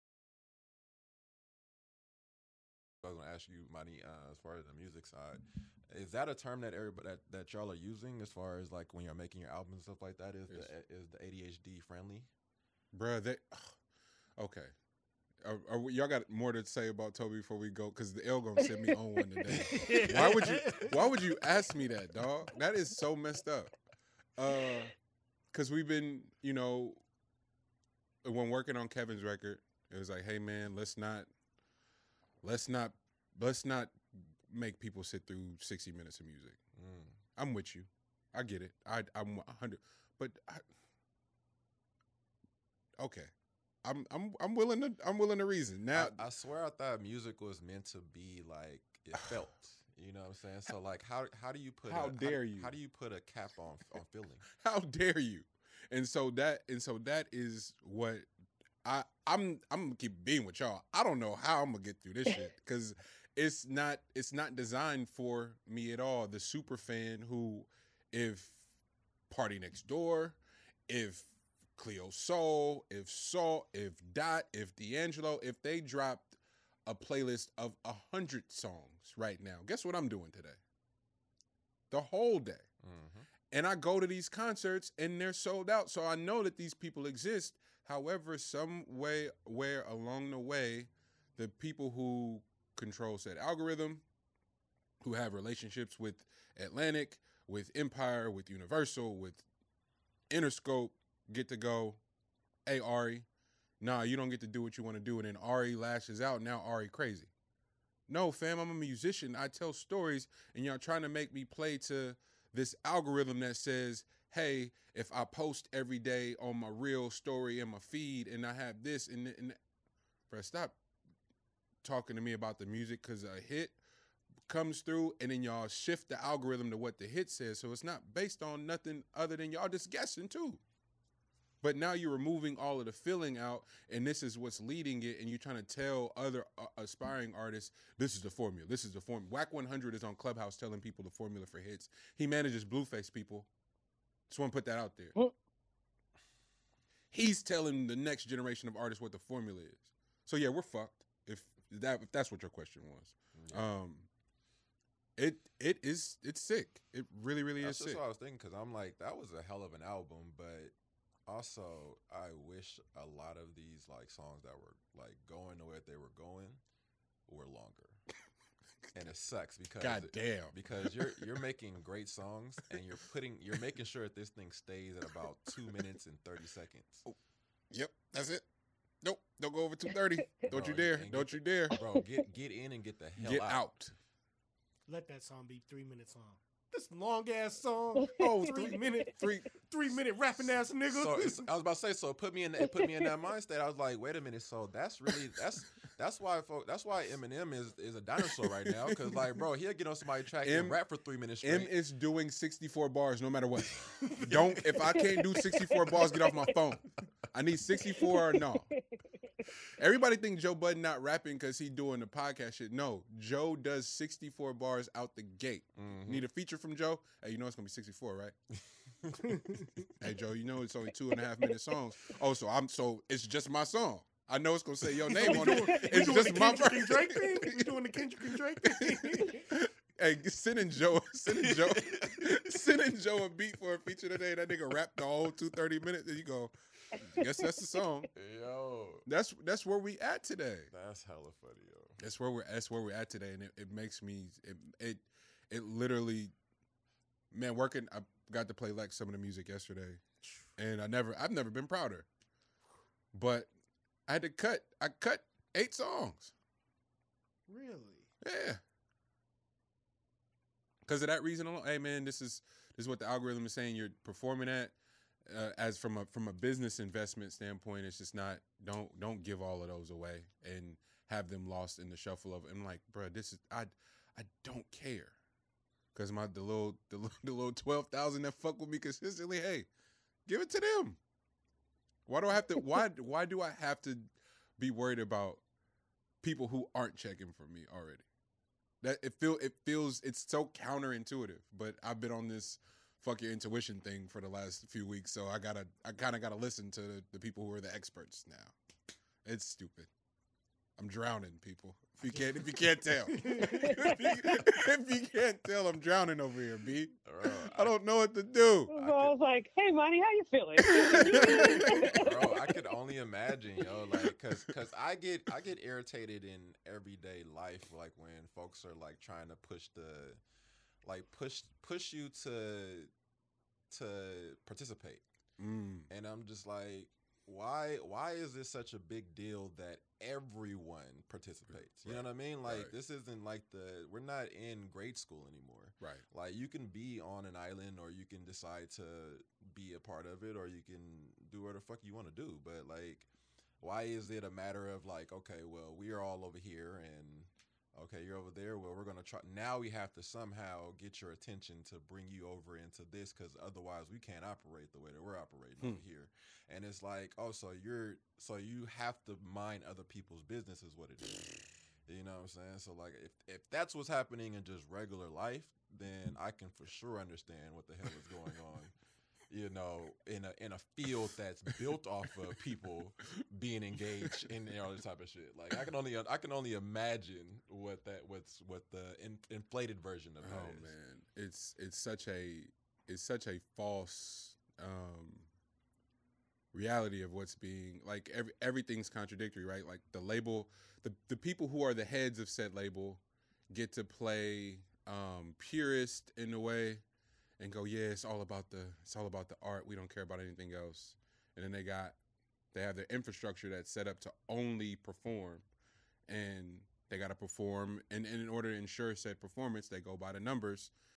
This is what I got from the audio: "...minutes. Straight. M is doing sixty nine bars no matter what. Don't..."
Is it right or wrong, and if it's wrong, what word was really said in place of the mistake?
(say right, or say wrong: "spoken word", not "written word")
wrong: "four", not "nine".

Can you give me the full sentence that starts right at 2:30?
So yeah, we're fucked if that if that's what your question was.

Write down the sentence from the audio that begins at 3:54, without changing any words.
That nigga rapped the whole two thirty minutes.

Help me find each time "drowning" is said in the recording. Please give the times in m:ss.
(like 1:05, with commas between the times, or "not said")
5:00, 5:05.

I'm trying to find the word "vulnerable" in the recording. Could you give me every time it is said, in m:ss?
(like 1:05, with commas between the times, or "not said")
not said.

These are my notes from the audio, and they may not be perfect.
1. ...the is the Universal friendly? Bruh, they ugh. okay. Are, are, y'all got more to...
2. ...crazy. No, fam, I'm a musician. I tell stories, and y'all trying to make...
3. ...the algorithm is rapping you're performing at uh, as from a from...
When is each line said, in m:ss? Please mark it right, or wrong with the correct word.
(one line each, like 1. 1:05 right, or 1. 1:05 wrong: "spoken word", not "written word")
1. 0:10 wrong: "ADHD", not "Universal"
2. 1:46 right
3. 4:22 wrong: "saying", not "rapping".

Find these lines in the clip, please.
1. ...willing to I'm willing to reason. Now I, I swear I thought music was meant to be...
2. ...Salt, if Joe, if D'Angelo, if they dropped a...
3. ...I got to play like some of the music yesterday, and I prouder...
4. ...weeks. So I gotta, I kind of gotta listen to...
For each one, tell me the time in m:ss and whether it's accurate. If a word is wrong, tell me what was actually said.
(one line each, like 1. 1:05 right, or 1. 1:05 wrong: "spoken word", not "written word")
1. 0:44 right
2. 1:13 wrong: "Dot", not "Joe"
3. 4:07 wrong: "never", not "prouder"
4. 4:54 right.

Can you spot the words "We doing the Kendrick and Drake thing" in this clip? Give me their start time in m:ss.
3:47.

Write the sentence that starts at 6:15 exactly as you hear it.
Like I can only I can only imagine what that what's what the in, inflated version of that oh, is.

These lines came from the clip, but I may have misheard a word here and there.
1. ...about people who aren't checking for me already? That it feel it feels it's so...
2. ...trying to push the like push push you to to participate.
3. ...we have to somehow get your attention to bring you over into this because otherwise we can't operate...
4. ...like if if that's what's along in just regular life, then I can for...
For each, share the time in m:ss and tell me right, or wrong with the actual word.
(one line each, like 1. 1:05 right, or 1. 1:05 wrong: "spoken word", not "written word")
1. 4:44 right
2. 5:18 right
3. 5:49 right
4. 6:02 wrong: "happening", not "along".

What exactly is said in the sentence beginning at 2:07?
So it's not based on nothing other than y'all just guessing too.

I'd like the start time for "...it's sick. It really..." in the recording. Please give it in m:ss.
2:36.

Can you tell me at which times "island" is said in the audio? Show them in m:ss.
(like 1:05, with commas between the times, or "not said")
5:37.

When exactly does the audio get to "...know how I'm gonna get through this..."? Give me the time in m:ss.
1:01.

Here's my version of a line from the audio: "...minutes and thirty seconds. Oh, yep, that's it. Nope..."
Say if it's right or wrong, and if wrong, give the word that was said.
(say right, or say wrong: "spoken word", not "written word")
right.